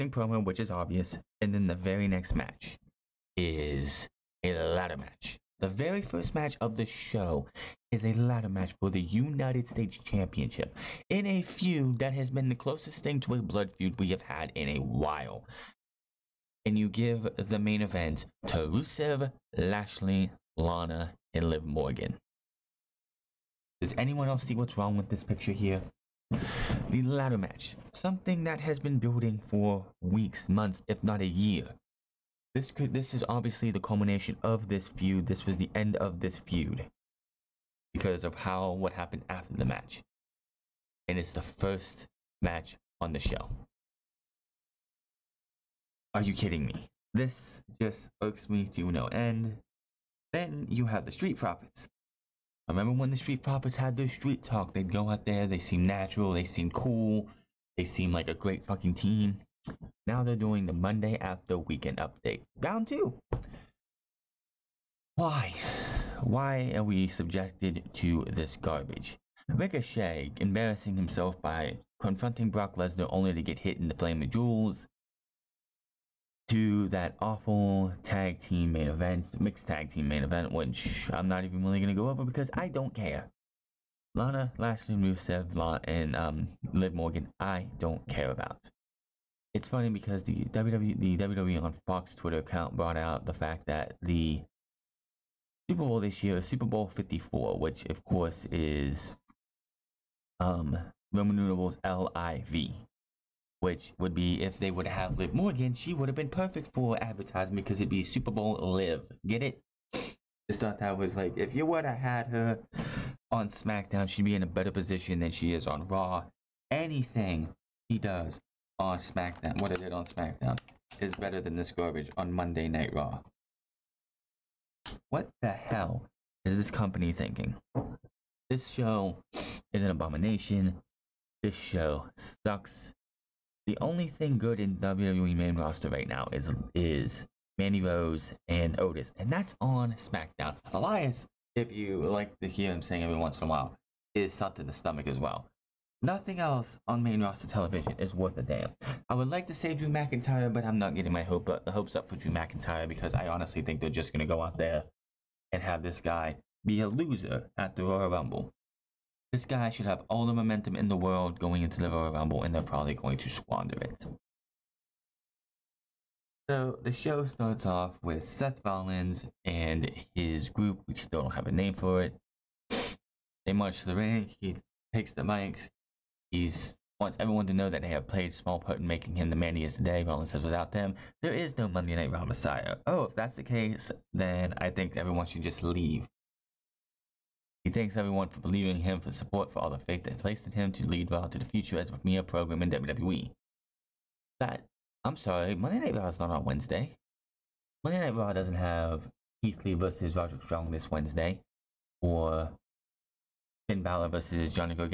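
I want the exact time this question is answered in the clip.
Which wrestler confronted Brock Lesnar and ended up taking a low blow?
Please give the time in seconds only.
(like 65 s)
69 s.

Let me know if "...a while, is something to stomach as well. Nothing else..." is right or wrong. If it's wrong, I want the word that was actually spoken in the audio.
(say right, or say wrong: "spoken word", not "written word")
right.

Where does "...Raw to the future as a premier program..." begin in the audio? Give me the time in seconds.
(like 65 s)
191 s.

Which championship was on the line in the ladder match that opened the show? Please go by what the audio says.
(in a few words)
United States Championship.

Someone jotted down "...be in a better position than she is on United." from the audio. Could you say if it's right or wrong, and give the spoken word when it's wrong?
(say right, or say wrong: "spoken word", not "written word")
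wrong: "Raw", not "United".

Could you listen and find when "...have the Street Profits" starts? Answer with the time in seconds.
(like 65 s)
50 s.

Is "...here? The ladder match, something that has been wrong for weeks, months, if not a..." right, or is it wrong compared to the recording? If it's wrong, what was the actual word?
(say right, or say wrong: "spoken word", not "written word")
wrong: "building", not "wrong".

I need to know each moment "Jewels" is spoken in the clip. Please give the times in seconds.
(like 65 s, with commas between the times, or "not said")
74 s.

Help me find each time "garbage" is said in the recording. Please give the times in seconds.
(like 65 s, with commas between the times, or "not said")
68 s, 121 s.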